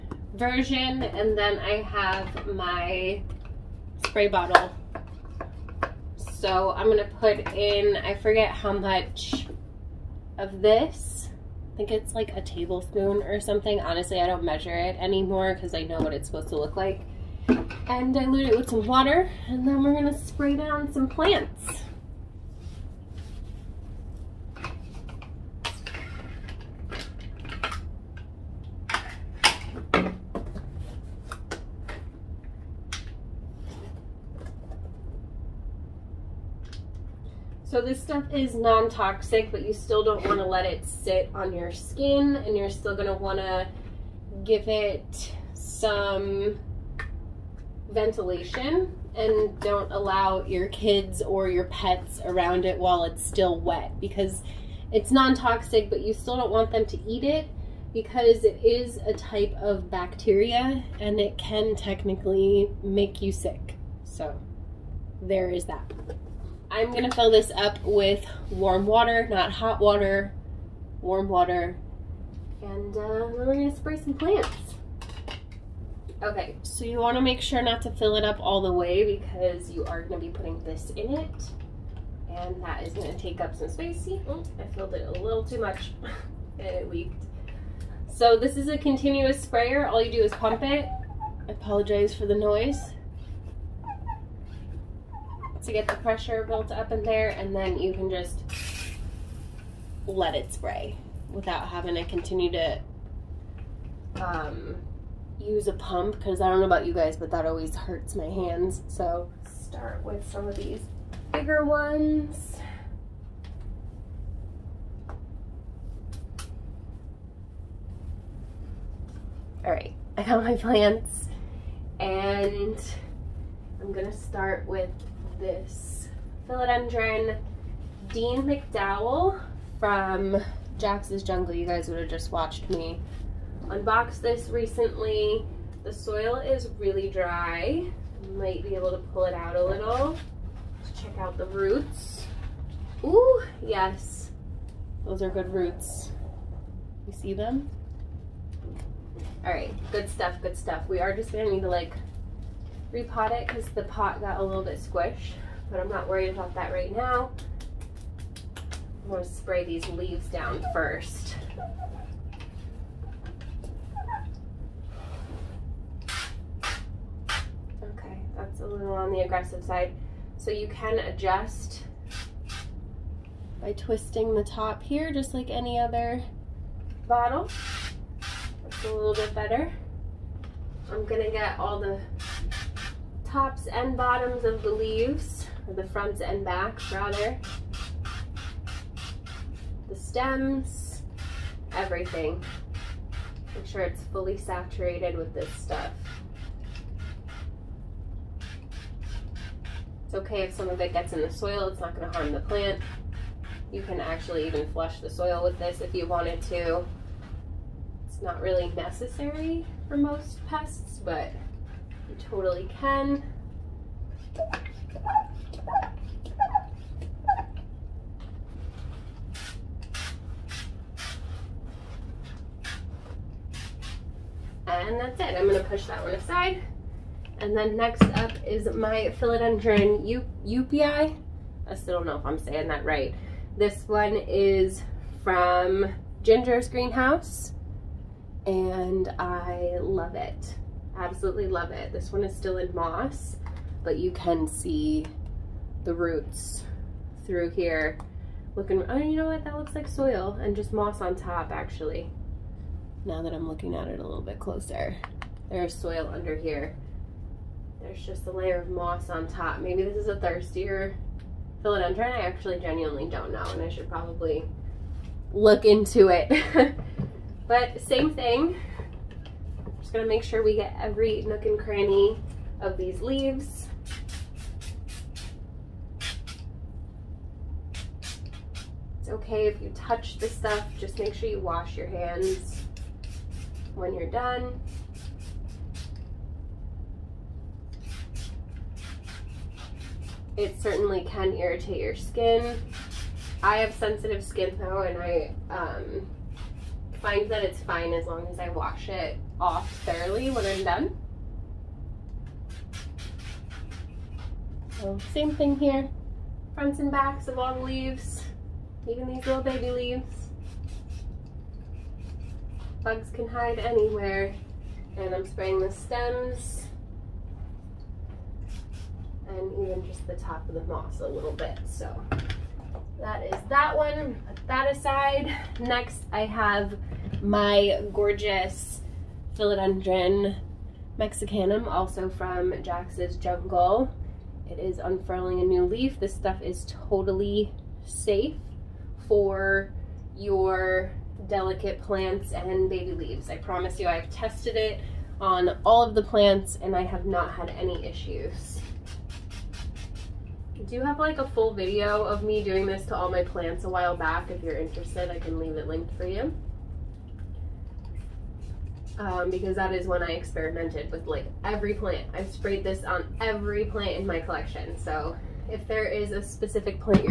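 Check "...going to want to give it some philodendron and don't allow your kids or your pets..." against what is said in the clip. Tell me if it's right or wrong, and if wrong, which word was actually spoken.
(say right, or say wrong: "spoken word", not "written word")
wrong: "ventilation", not "philodendron".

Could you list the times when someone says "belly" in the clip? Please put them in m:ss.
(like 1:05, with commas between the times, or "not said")
not said.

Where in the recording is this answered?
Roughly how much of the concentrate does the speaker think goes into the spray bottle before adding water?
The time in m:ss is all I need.
0:12.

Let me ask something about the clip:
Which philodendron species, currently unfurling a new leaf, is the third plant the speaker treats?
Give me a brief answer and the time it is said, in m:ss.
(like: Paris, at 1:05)
mexicanum, at 5:29.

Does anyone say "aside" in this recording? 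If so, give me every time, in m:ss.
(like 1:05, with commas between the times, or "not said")
3:46, 5:24.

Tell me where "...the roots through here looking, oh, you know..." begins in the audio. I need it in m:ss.
4:05.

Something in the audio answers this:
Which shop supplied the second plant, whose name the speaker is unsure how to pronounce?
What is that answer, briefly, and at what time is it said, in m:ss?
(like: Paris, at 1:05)
Ginger's Greenhouse, at 3:56.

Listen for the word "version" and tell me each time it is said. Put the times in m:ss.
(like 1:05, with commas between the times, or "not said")
0:00.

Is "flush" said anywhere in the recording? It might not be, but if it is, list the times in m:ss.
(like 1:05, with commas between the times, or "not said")
3:24.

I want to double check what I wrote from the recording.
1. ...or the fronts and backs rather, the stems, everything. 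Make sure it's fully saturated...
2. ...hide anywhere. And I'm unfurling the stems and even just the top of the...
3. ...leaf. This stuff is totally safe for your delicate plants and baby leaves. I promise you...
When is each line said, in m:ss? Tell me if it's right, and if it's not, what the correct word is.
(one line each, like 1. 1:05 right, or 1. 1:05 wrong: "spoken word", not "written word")
1. 3:05 right
2. 5:13 wrong: "spraying", not "unfurling"
3. 5:35 right.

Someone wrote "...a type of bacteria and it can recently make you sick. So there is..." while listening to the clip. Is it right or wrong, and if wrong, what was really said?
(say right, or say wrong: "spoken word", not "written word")
wrong: "technically", not "recently".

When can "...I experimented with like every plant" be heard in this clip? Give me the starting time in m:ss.
6:00.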